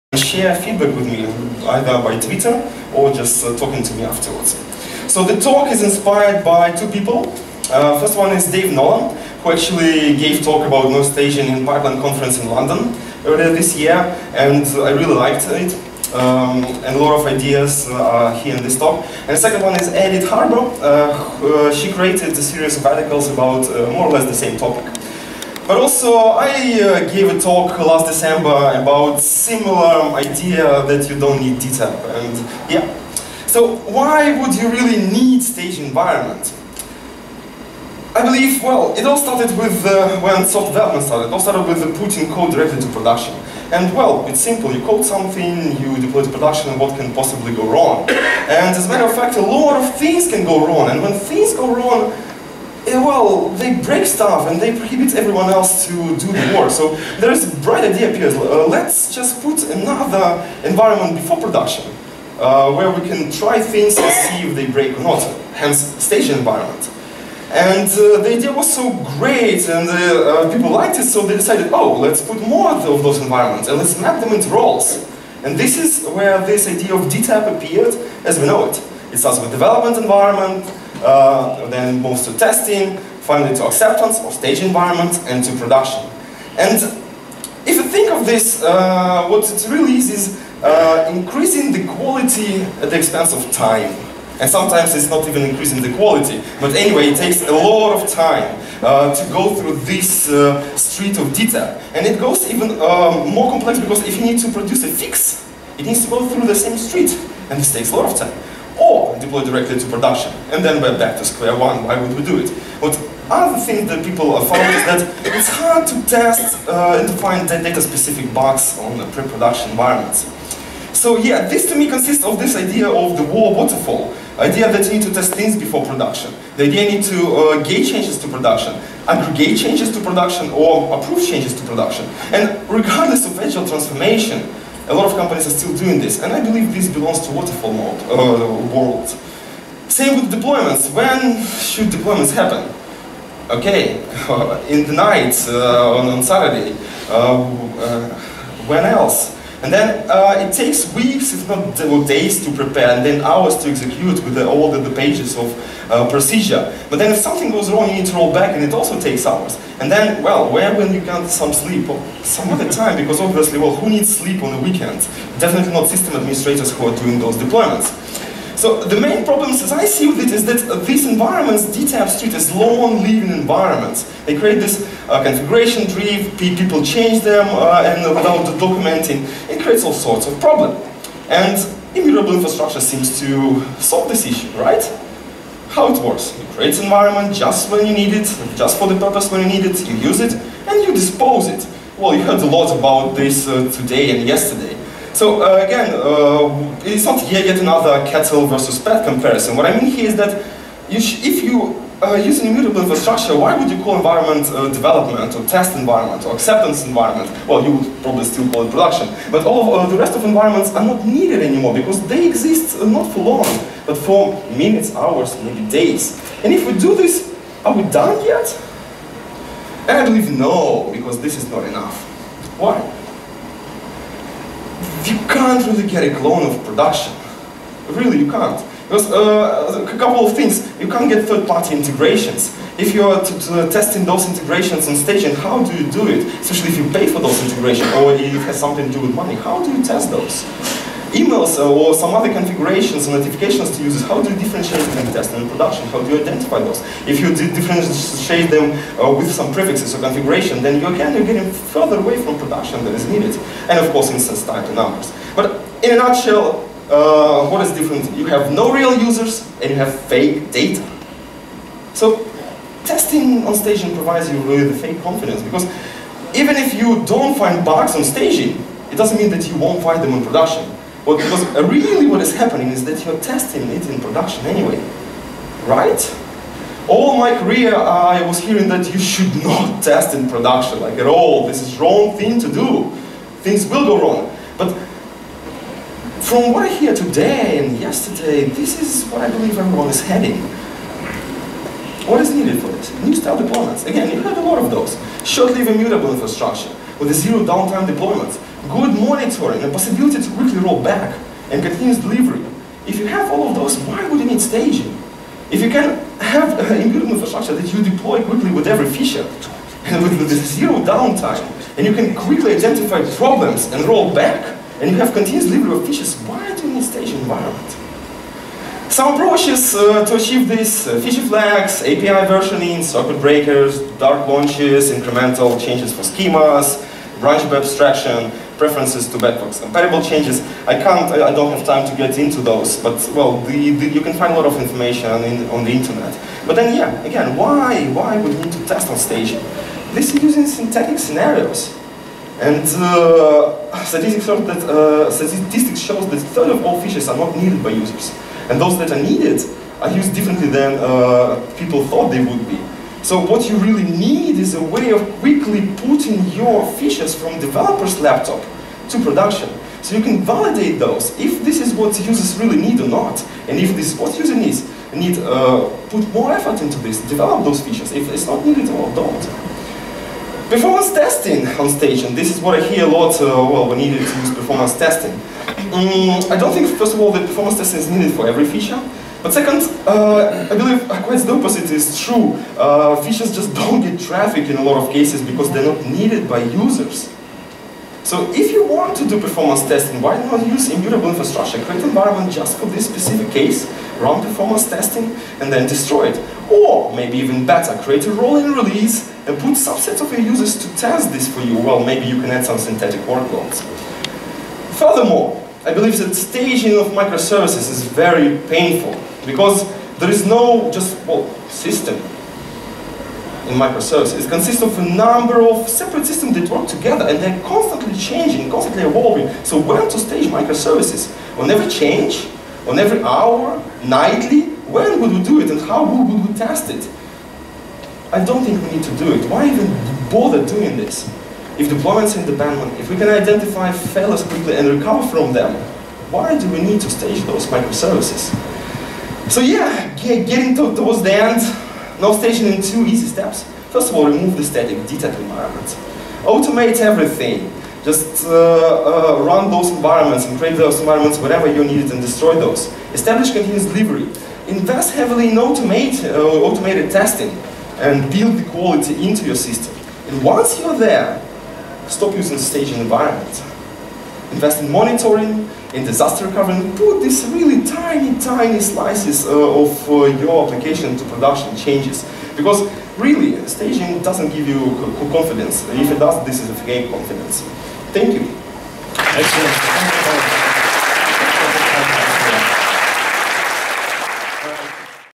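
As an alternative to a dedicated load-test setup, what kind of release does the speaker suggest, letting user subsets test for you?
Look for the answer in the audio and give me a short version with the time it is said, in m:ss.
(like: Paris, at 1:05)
Rolling release, at 6:38.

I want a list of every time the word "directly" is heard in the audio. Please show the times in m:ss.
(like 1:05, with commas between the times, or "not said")
0:42, 1:49.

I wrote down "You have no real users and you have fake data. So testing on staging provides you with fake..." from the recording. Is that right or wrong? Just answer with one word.
right.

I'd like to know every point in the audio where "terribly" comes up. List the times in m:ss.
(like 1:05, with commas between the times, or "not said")
not said.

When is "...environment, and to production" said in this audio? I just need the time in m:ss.
1:24.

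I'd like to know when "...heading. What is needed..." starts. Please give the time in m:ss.
4:50.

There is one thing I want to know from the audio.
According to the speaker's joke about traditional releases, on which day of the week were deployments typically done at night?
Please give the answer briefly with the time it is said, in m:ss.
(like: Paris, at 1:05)
Saturday, at 2:26.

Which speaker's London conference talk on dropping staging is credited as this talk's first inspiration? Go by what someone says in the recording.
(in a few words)
Dave Nolan.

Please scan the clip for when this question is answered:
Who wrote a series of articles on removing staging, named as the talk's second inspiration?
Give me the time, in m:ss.
0:19.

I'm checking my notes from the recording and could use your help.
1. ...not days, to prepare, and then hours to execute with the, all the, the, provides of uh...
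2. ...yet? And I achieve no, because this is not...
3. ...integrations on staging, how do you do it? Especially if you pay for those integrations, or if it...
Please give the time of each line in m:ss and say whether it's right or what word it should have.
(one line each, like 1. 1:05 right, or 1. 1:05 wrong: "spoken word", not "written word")
1. 2:31 wrong: "pages", not "provides"
2. 3:38 wrong: "believe", not "achieve"
3. 3:54 right.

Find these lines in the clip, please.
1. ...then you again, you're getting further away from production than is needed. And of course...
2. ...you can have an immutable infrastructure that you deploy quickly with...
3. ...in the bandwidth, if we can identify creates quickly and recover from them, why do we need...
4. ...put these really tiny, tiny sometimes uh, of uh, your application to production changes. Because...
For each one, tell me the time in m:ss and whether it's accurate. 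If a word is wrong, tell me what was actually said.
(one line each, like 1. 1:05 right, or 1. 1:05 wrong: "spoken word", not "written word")
1. 4:10 right
2. 5:05 right
3. 7:12 wrong: "failures", not "creates"
4. 7:46 wrong: "slices", not "sometimes".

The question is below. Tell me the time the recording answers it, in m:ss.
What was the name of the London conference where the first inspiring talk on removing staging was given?
0:11.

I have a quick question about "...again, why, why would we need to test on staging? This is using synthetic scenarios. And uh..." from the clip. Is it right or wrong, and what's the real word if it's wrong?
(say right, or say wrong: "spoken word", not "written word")
right.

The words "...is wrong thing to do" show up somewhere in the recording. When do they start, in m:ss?
4:41.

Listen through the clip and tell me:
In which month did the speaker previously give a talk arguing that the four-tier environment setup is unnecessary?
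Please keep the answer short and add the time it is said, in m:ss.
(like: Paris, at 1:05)
December, at 0:28.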